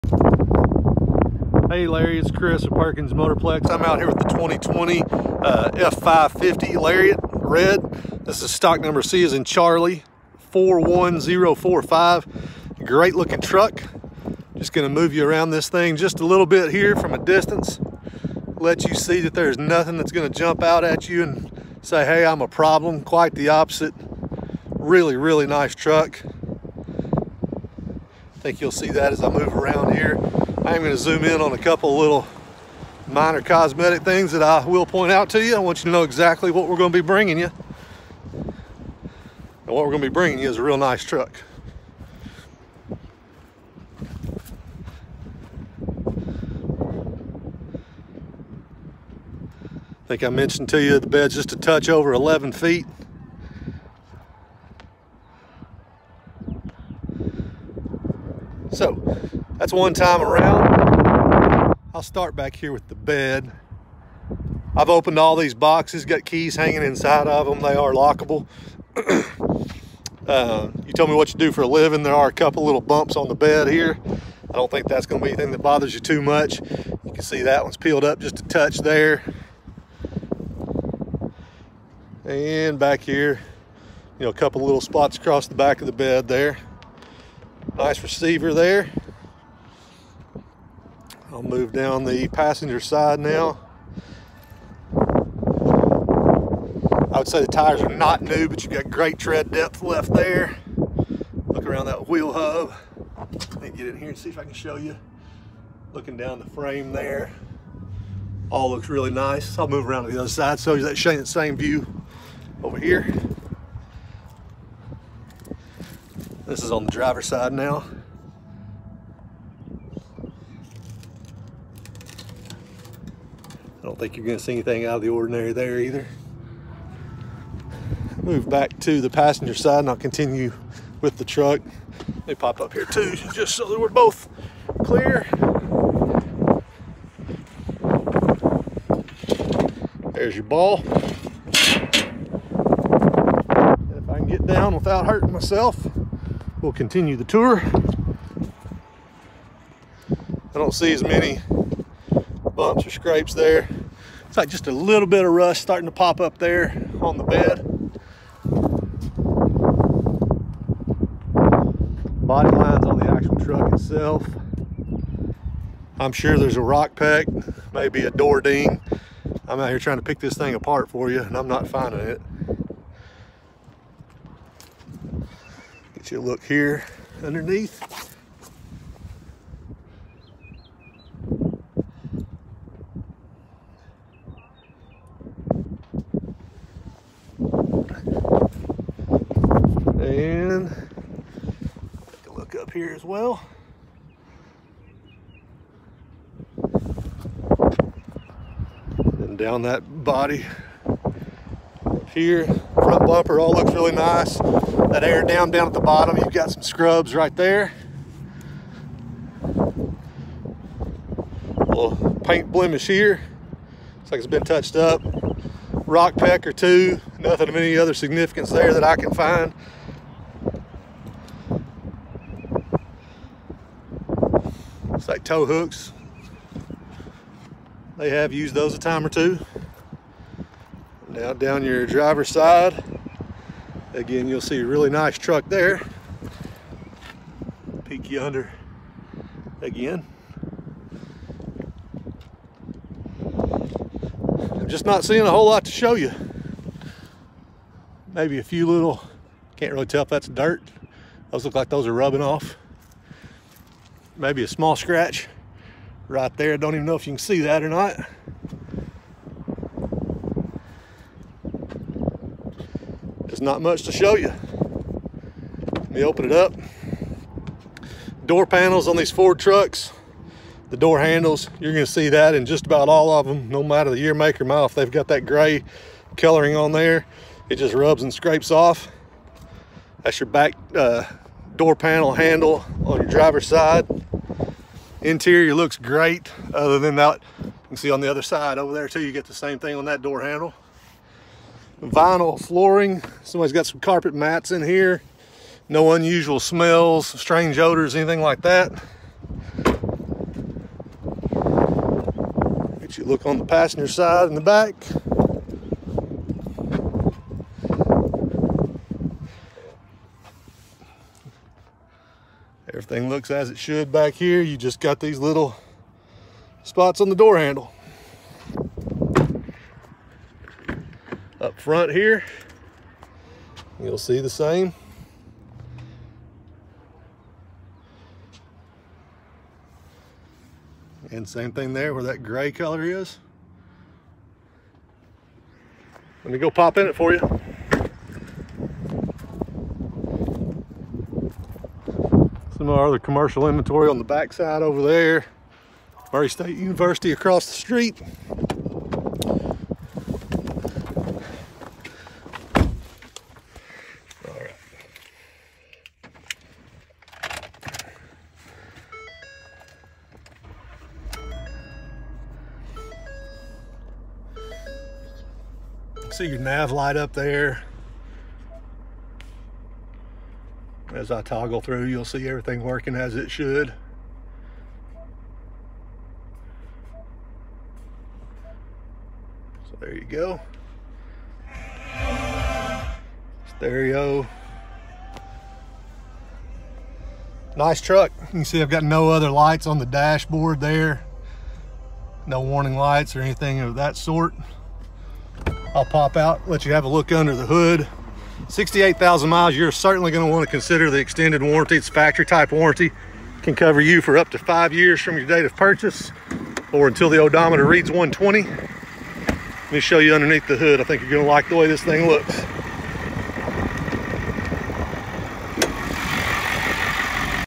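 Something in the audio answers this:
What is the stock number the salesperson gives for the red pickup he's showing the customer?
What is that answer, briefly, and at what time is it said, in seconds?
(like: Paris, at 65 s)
C41045, at 9 s.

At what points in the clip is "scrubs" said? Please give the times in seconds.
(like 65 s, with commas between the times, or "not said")
206 s.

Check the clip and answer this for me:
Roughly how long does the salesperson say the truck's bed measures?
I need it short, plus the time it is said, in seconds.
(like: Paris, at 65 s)
a touch over 11 feet, at 51 s.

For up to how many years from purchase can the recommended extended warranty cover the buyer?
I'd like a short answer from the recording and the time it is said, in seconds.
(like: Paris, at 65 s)
5 years, at 404 s.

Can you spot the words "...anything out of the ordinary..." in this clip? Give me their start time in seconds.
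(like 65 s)
124 s.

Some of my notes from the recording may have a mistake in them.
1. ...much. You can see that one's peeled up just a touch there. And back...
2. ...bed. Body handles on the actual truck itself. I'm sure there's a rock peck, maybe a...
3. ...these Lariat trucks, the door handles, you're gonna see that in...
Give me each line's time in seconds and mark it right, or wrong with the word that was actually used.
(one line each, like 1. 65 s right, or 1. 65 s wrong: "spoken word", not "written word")
1. 76 s right
2. 157 s wrong: "lines", not "handles"
3. 268 s wrong: "Ford", not "Lariat".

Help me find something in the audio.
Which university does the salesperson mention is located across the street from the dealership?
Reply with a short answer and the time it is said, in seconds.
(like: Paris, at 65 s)
Murray State University, at 346 s.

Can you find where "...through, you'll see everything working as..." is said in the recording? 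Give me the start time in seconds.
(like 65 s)
371 s.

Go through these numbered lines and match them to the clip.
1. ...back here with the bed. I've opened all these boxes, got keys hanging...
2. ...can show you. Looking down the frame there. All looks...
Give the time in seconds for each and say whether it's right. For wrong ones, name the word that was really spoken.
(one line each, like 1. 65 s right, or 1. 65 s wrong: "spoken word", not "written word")
1. 62 s right
2. 104 s right.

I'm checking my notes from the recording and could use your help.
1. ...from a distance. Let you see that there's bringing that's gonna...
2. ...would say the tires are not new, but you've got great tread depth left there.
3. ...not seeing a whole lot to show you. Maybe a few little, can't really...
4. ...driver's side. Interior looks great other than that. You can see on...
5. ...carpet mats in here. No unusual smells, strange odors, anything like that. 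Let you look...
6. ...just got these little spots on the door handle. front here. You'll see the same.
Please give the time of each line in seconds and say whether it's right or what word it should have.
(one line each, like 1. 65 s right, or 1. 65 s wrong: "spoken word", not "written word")
1. 16 s wrong: "nothing", not "bringing"
2. 97 s right
3. 244 s right
4. 283 s right
5. 293 s right
6. 314 s right.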